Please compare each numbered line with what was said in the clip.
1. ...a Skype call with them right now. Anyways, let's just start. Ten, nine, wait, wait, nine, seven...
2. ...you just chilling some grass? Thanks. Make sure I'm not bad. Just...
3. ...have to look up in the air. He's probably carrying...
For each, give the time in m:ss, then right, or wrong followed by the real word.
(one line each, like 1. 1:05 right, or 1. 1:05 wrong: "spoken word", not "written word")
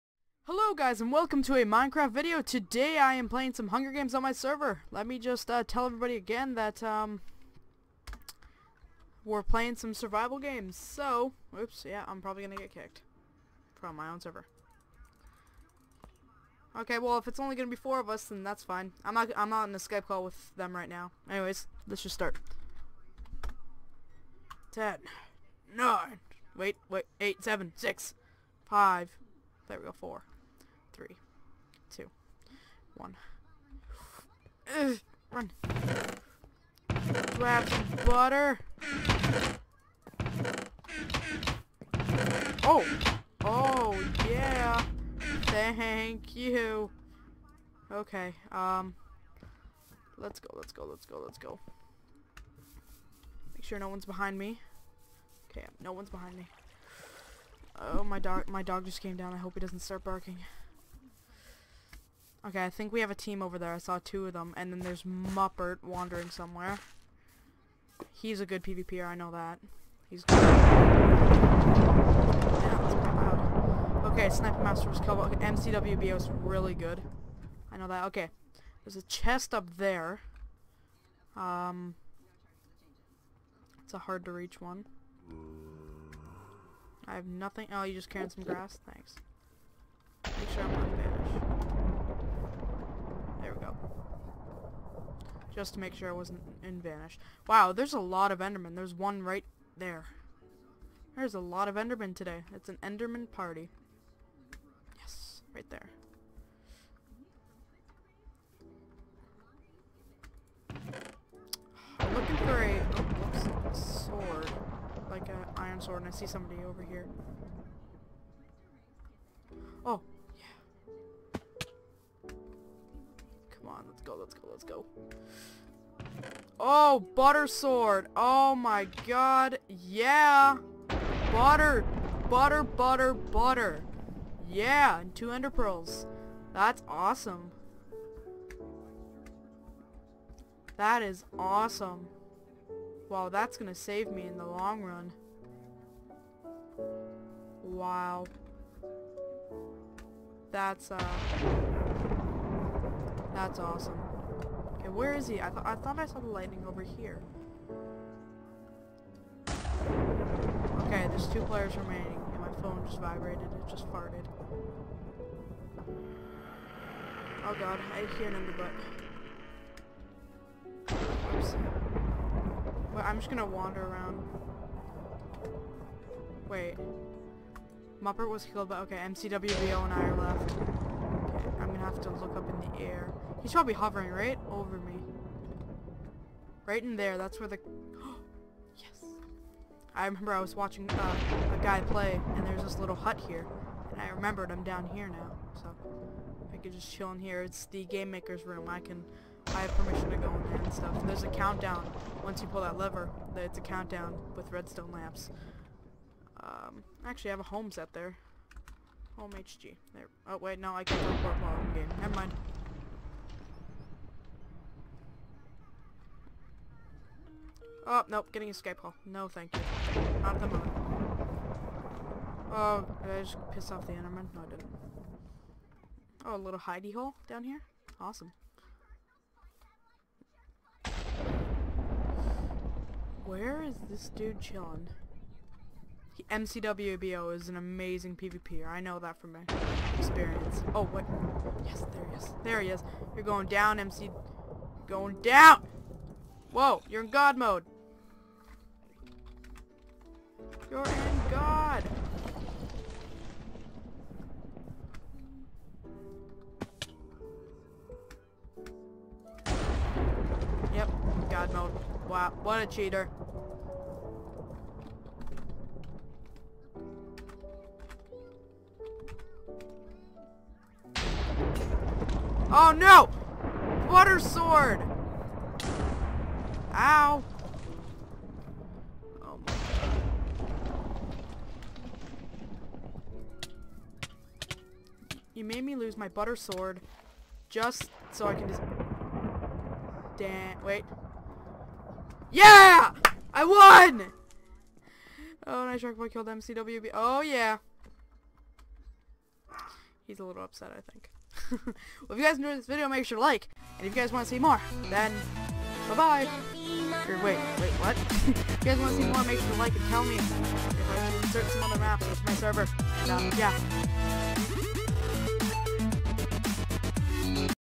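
1. 0:19 wrong: "eight", not "nine"
2. 1:27 wrong: "carrying", not "chilling"
3. 3:01 wrong: "hovering", not "carrying".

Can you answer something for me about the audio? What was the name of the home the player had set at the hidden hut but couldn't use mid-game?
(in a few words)
HG.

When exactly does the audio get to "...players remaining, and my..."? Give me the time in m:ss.
2:41.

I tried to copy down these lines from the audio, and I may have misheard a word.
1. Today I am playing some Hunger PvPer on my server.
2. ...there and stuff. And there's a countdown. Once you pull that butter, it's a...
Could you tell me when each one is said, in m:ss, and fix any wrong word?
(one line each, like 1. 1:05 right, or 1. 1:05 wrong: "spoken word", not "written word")
1. 0:02 wrong: "Games", not "PvPer"
2. 3:20 wrong: "lever", not "butter".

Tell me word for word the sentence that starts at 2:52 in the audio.
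Well, I'm just gonna wander around.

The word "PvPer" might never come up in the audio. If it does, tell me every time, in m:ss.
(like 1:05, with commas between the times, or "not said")
1:08, 3:58.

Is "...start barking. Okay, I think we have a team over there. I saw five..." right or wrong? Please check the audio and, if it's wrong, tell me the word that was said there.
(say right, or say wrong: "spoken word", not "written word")
wrong: "two", not "five".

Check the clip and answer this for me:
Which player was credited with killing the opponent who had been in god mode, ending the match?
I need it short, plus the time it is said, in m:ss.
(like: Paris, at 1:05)
Shark Boy, at 4:55.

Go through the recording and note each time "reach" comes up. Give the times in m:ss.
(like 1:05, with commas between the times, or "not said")
1:24.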